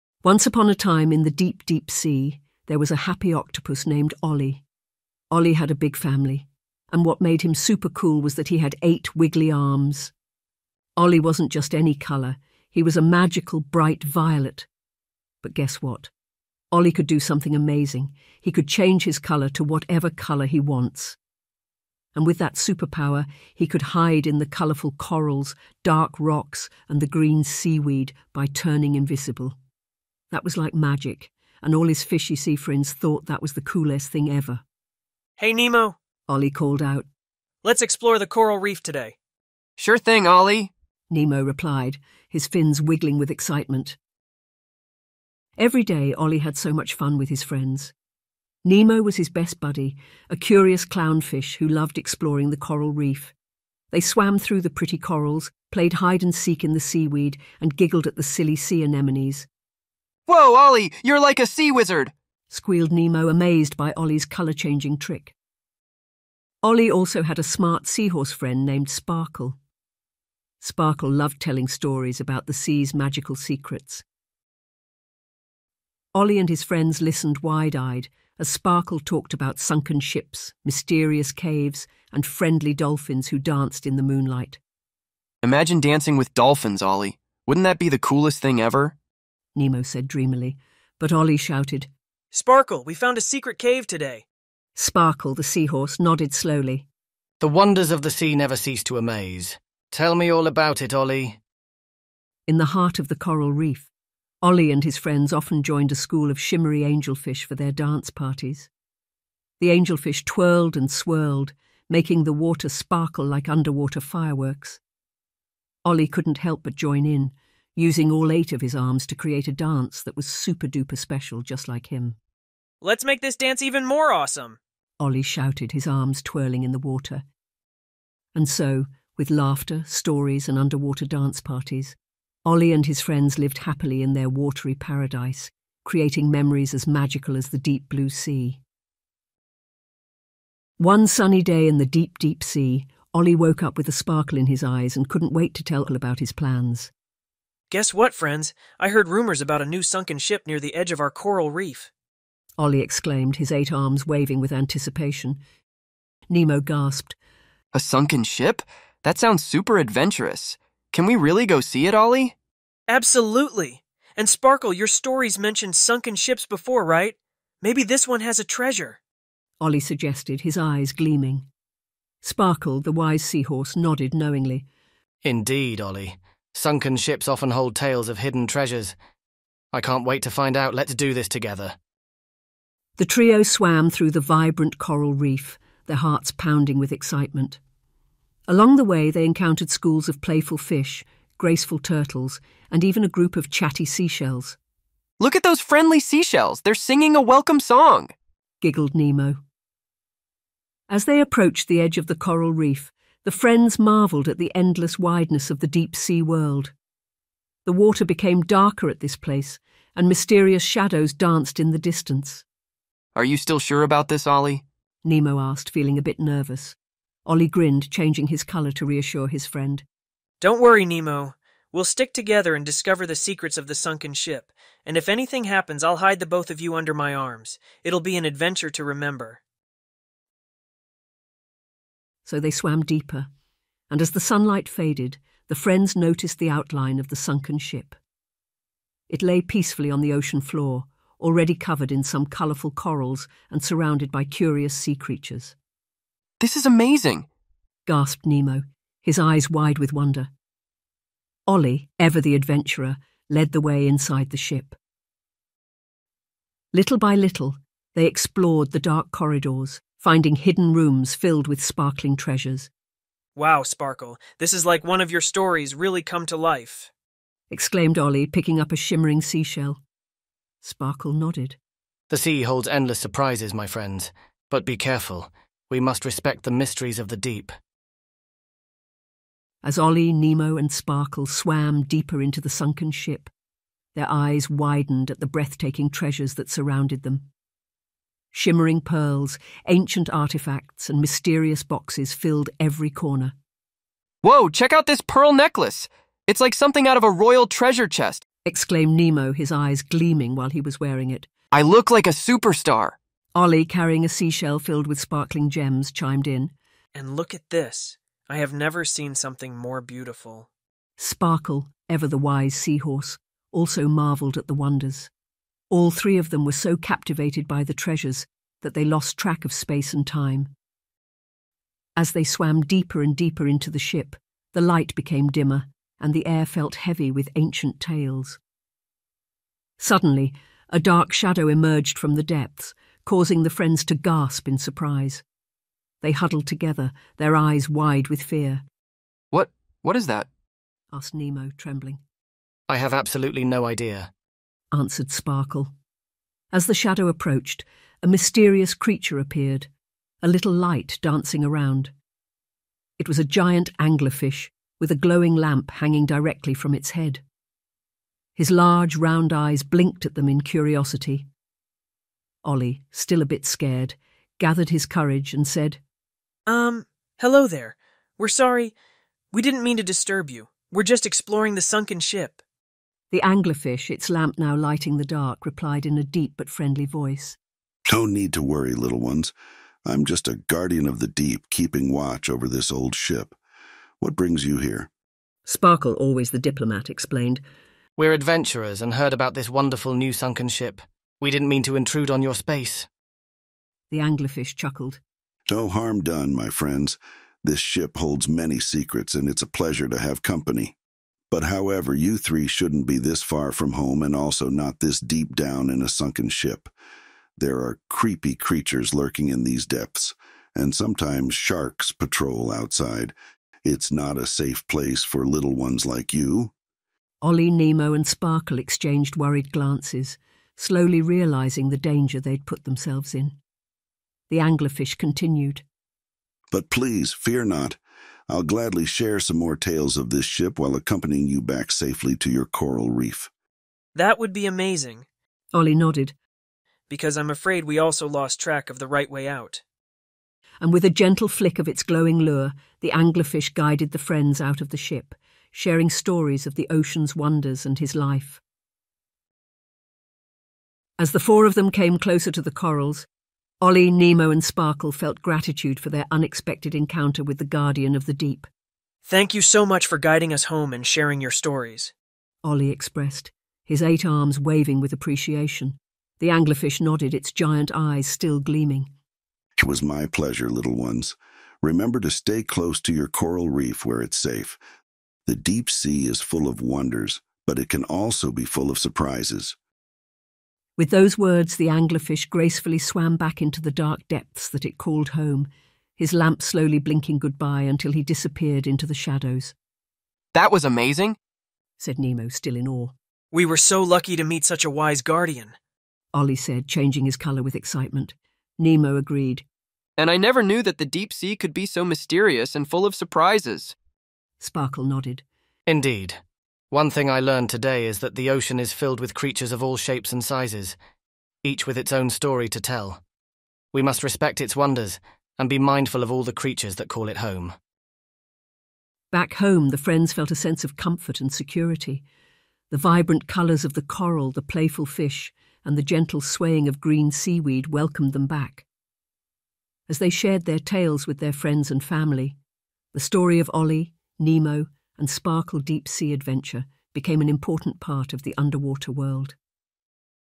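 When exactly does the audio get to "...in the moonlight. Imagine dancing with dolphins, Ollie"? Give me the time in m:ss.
1:23.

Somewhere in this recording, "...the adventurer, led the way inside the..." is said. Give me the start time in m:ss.
4:12.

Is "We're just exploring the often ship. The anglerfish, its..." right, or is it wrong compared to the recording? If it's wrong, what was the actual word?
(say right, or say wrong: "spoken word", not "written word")
wrong: "sunken", not "often".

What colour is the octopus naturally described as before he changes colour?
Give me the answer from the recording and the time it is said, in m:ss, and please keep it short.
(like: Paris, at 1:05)
violet, at 0:13.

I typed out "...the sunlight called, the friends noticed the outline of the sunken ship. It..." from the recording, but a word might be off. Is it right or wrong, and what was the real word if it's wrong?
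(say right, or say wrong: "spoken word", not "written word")
wrong: "faded", not "called".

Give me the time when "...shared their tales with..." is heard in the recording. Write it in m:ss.
8:50.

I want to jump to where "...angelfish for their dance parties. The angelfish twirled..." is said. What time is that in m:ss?
1:46.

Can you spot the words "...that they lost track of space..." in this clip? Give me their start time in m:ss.
5:18.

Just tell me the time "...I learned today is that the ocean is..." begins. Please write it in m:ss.
8:27.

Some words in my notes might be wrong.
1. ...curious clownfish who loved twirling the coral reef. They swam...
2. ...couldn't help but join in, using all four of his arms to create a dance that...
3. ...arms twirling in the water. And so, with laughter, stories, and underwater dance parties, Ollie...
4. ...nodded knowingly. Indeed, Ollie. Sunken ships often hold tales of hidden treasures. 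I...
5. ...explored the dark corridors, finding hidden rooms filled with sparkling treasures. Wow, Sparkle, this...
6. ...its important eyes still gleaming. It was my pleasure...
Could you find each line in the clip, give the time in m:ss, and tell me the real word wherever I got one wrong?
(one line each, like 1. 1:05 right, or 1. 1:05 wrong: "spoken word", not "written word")
1. 0:50 wrong: "exploring", not "twirling"
2. 1:56 wrong: "eight", not "four"
3. 2:05 right
4. 2:53 right
5. 4:18 right
6. 7:47 wrong: "giant", not "important".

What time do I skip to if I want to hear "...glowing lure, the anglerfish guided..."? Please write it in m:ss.
7:21.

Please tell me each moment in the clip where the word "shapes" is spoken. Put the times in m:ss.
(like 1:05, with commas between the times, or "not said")
8:29.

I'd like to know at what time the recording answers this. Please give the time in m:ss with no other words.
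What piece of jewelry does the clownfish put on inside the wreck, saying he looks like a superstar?
4:55.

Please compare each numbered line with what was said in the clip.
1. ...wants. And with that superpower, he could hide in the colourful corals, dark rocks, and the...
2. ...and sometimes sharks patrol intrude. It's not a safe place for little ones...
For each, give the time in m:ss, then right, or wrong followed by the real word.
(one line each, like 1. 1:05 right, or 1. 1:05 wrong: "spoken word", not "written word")
1. 0:20 right
2. 6:50 wrong: "outside", not "intrude".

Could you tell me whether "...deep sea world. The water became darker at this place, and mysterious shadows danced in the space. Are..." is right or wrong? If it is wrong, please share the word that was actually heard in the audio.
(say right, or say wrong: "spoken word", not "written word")
wrong: "distance", not "space".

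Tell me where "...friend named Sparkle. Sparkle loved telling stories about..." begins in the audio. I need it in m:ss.
1:08.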